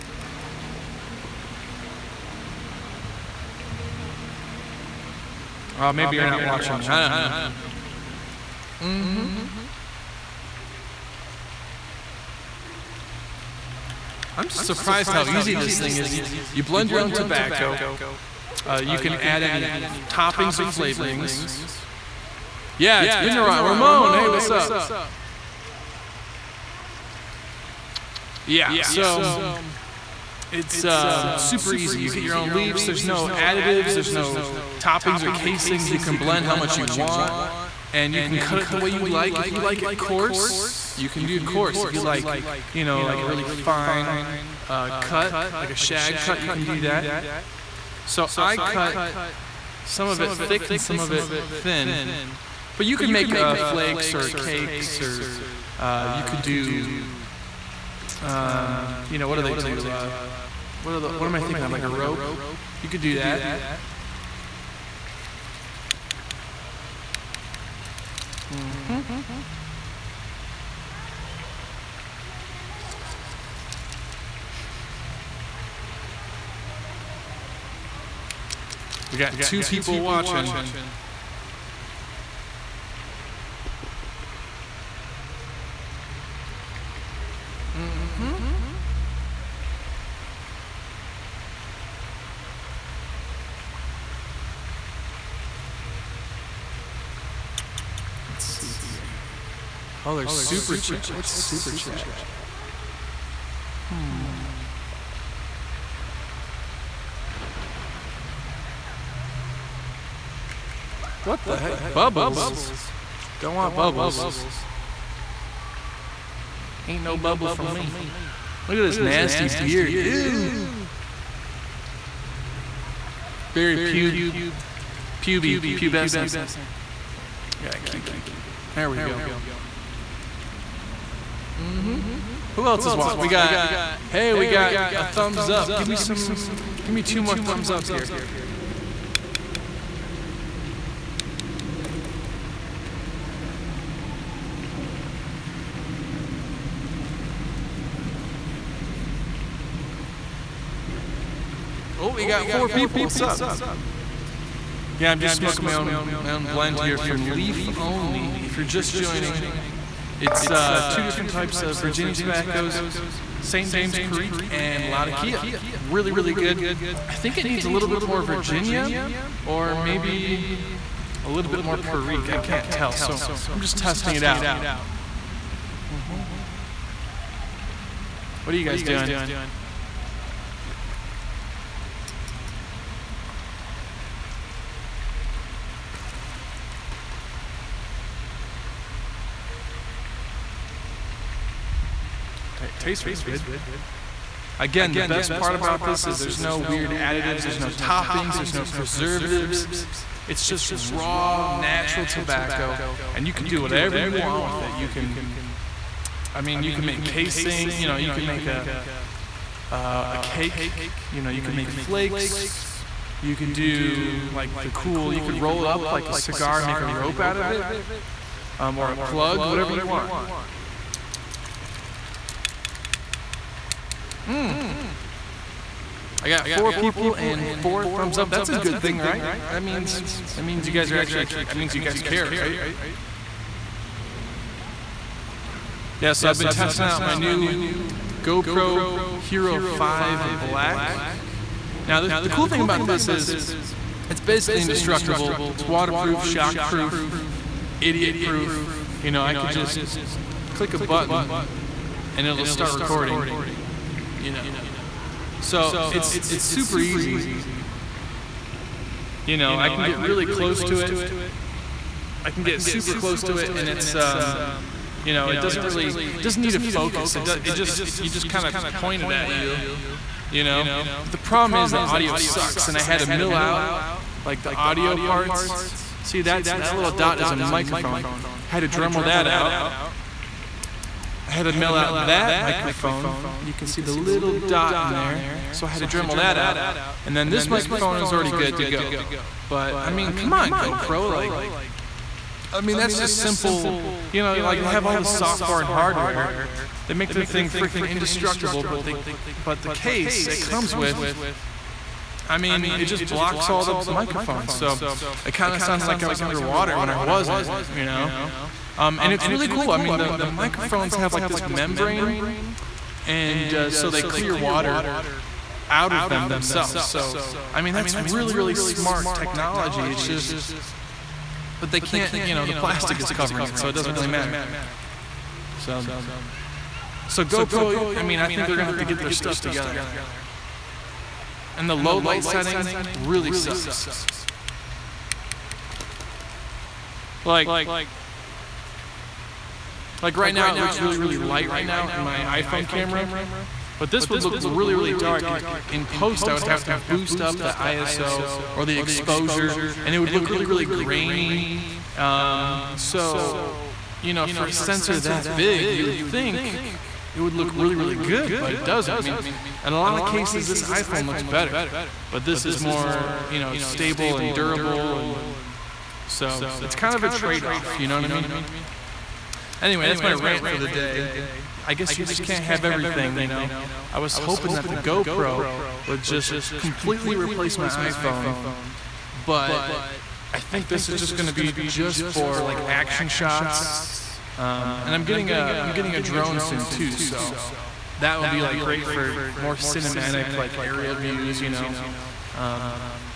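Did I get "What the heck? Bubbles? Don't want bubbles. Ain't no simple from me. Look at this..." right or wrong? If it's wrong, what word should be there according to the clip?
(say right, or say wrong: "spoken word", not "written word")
wrong: "bubble", not "simple".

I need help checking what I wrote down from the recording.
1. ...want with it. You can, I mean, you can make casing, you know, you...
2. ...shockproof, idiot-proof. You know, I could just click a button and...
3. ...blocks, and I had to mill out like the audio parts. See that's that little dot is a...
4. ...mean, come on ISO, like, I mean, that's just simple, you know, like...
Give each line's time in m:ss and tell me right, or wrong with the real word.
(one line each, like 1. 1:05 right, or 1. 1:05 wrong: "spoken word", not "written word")
1. 3:24 right
2. 4:06 right
3. 4:32 wrong: "sucks", not "blocks"
4. 4:49 wrong: "GoPro", not "ISO".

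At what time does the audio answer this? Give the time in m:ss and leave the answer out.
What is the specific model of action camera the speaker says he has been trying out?
3:58.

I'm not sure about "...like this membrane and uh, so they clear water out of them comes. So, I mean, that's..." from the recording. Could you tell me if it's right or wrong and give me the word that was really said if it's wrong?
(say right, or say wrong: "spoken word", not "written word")
wrong: "themselves", not "comes".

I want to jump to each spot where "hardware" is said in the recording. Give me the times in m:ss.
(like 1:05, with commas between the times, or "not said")
4:55.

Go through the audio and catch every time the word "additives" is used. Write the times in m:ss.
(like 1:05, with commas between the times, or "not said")
0:33, 3:16.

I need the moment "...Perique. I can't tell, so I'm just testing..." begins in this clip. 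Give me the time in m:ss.
2:51.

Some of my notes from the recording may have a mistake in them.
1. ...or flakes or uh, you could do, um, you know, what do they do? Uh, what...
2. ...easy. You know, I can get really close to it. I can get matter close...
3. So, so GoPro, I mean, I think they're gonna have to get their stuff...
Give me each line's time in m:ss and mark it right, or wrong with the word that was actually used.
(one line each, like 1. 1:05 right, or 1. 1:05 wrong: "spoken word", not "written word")
1. 0:54 wrong: "cakes", not "flakes"
2. 4:16 wrong: "super", not "matter"
3. 5:25 right.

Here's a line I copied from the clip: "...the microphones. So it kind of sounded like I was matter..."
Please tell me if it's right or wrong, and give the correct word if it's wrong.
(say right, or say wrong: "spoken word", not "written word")
wrong: "underwater", not "matter".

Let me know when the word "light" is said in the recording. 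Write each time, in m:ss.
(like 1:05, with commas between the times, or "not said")
5:31, 5:41.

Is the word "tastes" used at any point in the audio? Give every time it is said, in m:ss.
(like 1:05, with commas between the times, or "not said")
3:12.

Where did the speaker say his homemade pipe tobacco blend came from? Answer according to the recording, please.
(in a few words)
Leaf Only.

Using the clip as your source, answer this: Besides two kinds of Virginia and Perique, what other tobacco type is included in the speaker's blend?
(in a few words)
Latakia.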